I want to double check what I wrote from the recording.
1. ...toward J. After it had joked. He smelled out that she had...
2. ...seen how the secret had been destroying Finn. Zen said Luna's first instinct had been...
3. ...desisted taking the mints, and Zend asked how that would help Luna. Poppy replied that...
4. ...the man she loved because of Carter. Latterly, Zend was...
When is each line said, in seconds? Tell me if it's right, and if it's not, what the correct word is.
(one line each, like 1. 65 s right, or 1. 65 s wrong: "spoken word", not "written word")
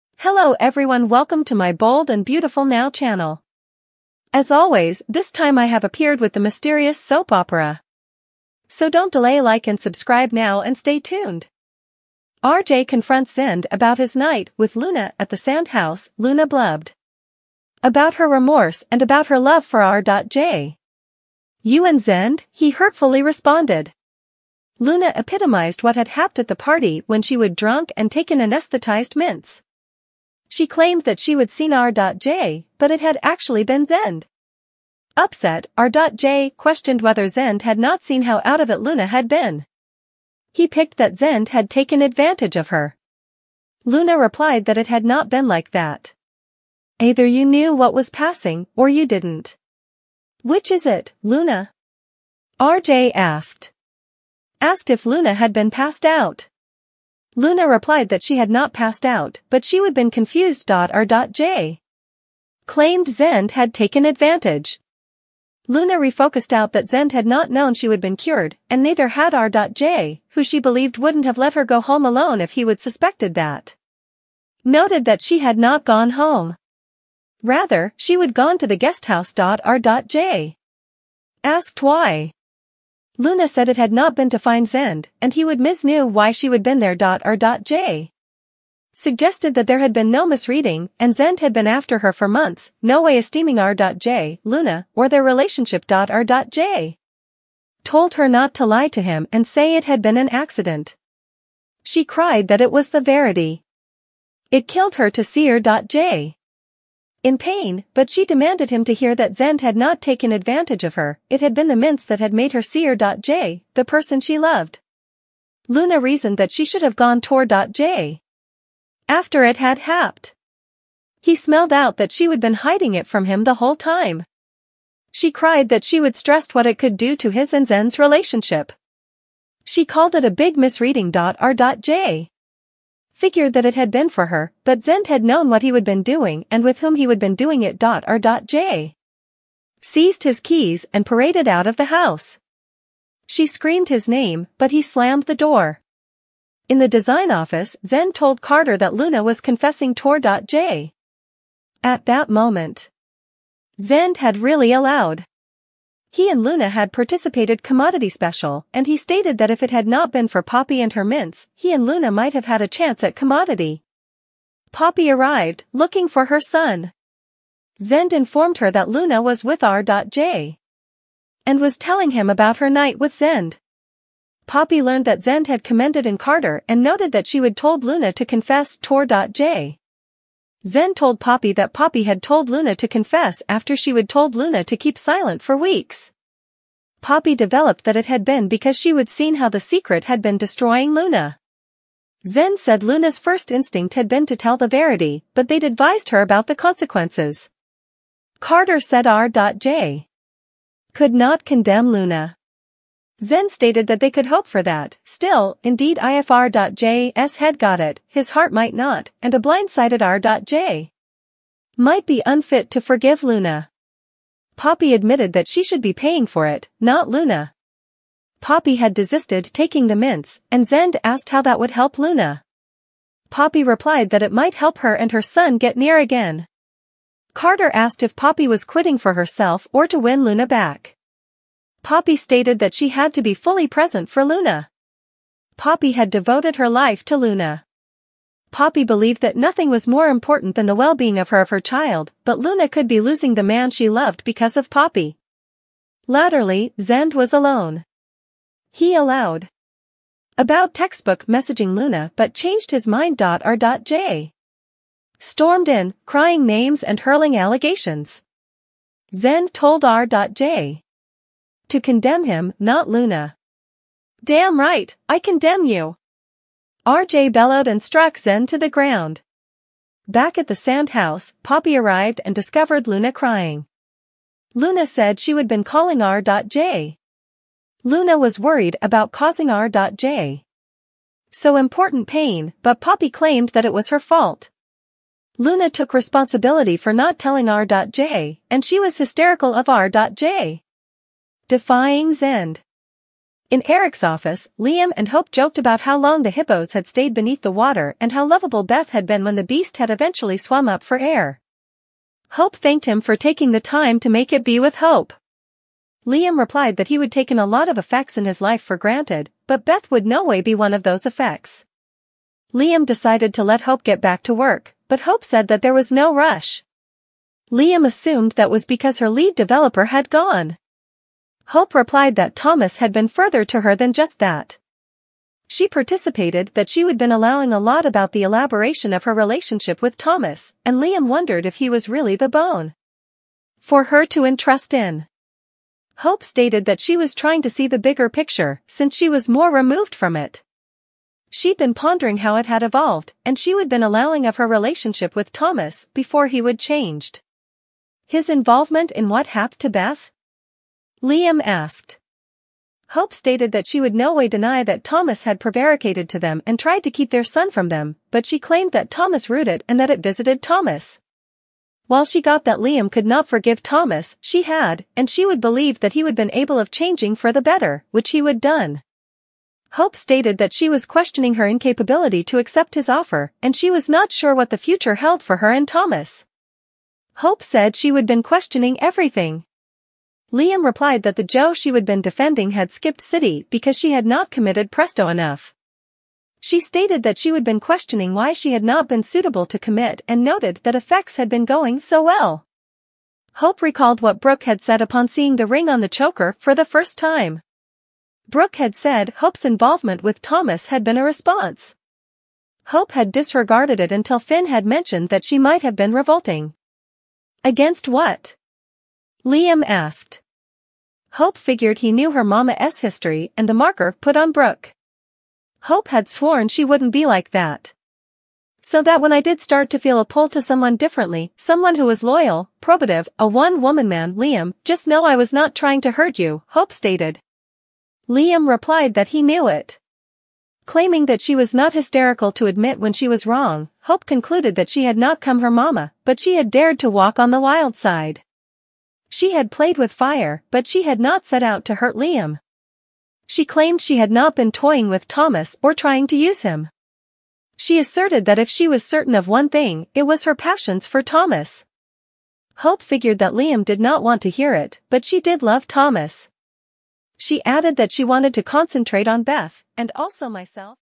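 1. 117 s wrong: "happed", not "joked"
2. 189 s wrong: "Luna", not "Finn"
3. 218 s right
4. 243 s wrong: "Poppy", not "Carter".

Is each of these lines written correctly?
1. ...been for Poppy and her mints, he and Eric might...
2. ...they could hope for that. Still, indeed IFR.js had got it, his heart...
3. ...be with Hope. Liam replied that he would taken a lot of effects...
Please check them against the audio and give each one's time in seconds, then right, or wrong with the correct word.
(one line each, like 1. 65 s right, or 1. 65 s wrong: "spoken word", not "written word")
1. 160 s wrong: "Luna", not "Eric"
2. 203 s right
3. 304 s right.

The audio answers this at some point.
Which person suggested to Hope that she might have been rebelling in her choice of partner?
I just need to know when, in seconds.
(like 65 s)
404 s.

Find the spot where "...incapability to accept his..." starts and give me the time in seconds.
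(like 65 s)
371 s.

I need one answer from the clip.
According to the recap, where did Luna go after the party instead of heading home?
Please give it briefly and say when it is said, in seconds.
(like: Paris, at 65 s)
The guesthouse, at 78 s.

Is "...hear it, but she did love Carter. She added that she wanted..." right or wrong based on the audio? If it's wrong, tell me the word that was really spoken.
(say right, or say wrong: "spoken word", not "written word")
wrong: "Thomas", not "Carter".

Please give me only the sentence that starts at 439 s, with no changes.
She had played with fire, but she had not set out to hurt Liam.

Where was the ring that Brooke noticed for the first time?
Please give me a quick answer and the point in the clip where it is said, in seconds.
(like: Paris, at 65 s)
On the choker, at 395 s.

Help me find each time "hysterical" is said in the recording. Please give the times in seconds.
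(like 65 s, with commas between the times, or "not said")
288 s, 431 s.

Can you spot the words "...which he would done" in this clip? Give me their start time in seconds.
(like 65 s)
367 s.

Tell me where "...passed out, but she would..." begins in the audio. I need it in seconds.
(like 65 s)
58 s.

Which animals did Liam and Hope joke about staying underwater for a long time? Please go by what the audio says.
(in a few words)
Hippos.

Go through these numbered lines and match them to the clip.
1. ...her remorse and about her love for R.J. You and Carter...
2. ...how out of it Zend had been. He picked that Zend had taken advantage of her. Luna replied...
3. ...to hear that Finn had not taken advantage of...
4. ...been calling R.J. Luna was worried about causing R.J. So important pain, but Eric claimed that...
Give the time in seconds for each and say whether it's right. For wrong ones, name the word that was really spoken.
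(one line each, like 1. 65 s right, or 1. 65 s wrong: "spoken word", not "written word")
1. 18 s wrong: "Zend", not "Carter"
2. 38 s wrong: "Luna", not "Zend"
3. 108 s wrong: "Zend", not "Finn"
4. 275 s wrong: "Poppy", not "Eric".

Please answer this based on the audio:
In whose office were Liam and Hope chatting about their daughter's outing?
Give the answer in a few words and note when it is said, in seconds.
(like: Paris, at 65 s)
Eric's office, at 293 s.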